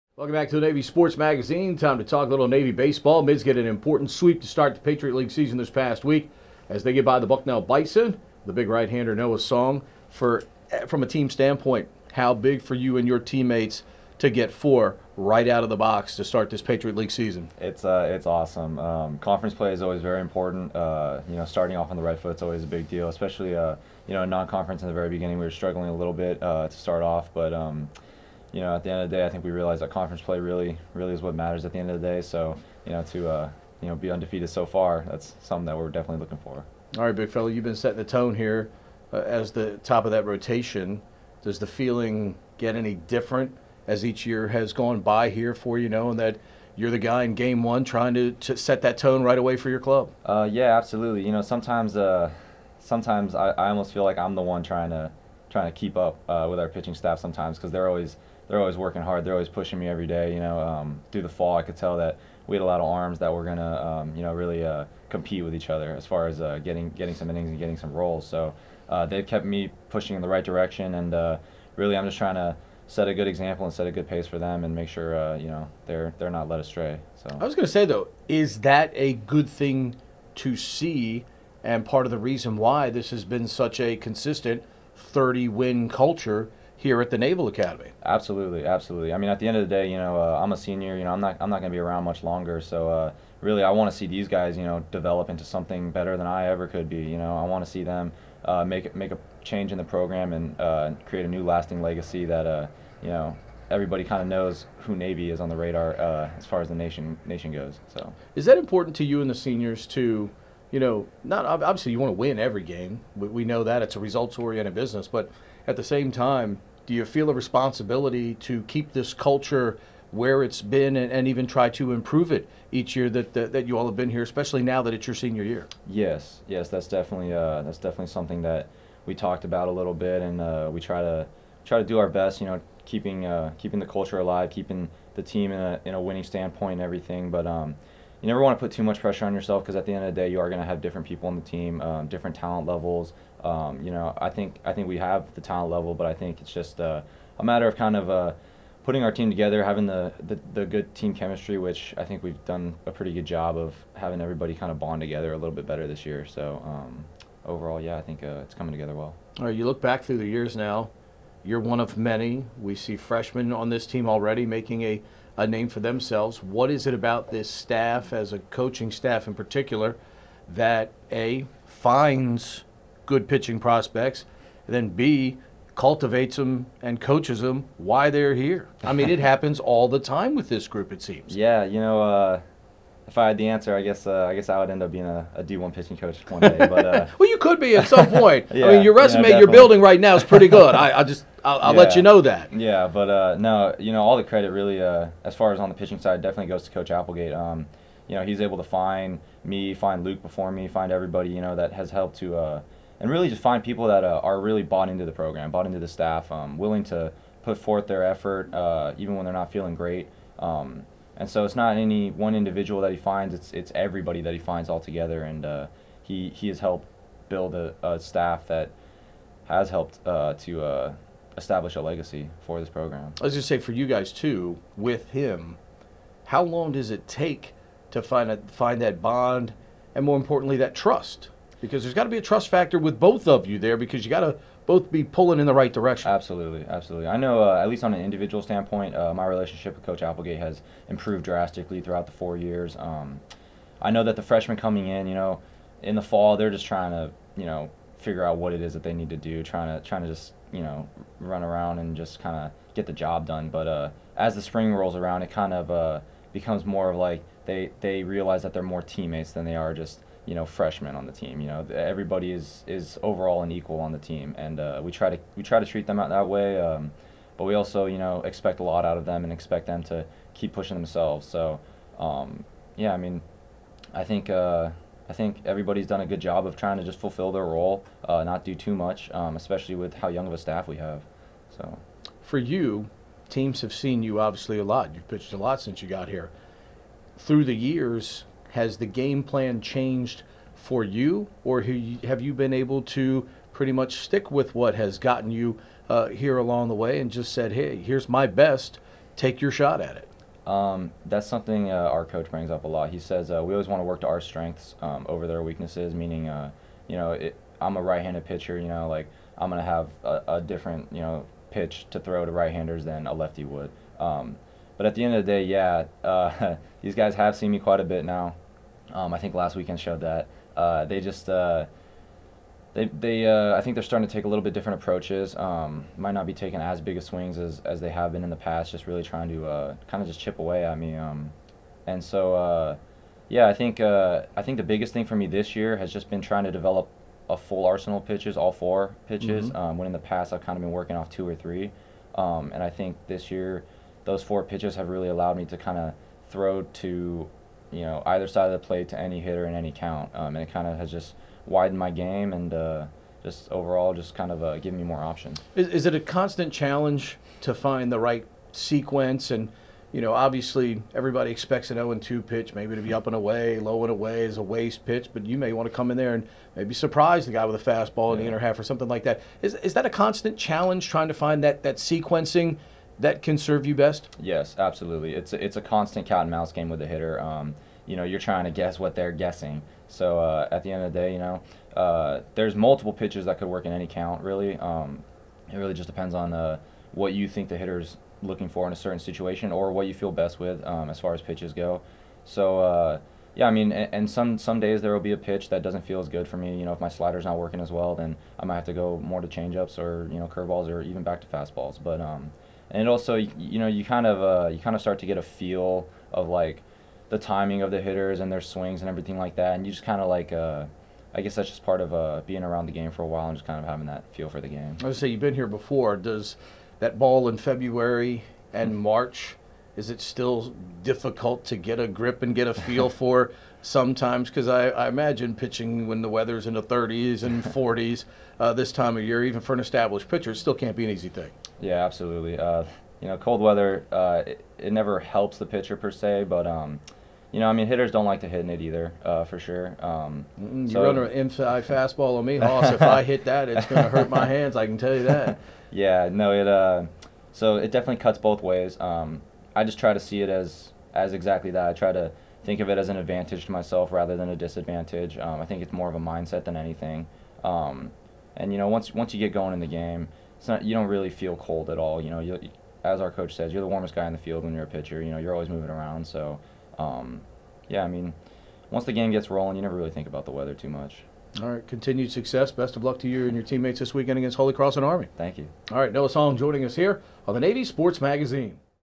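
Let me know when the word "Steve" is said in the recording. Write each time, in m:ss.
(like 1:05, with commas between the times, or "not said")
not said.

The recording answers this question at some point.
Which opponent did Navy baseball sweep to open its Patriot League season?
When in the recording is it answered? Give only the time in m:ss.
0:07.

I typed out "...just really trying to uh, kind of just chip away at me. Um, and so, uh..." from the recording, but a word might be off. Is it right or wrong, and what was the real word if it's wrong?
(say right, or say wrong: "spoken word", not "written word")
right.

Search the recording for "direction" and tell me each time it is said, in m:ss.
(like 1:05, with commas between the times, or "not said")
1:10, 3:55.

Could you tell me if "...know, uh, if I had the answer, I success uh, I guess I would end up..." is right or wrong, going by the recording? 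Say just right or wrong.
wrong.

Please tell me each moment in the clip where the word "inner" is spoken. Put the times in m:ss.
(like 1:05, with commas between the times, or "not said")
6:08.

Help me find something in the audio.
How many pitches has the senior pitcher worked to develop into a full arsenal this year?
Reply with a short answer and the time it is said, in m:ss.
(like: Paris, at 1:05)
4, at 5:38.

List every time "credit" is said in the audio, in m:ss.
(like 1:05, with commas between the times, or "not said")
3:14.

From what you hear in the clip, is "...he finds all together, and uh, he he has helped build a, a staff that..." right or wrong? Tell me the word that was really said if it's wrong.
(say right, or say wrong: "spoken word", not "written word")
right.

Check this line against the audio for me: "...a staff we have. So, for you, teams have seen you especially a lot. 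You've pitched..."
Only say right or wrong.
wrong.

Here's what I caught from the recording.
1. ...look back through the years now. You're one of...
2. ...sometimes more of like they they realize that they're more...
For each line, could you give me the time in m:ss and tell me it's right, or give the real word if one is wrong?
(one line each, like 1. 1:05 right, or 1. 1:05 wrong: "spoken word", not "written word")
1. 2:39 right
2. 4:16 wrong: "becomes", not "sometimes".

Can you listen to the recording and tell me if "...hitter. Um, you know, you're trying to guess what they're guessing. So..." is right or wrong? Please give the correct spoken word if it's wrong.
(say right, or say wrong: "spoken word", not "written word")
right.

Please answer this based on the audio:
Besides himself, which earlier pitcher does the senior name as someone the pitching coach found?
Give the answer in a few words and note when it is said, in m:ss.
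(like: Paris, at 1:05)
Luke, at 3:20.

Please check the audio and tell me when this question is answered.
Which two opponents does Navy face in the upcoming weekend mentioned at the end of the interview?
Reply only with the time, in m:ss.
7:54.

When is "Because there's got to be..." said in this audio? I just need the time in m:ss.
3:51.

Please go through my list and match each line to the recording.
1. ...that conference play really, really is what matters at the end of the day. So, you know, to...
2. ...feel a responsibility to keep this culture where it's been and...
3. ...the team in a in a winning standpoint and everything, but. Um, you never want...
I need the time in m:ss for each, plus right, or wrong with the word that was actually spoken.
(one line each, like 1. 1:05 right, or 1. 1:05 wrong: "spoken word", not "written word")
1. 0:29 right
2. 1:57 right
3. 2:15 right.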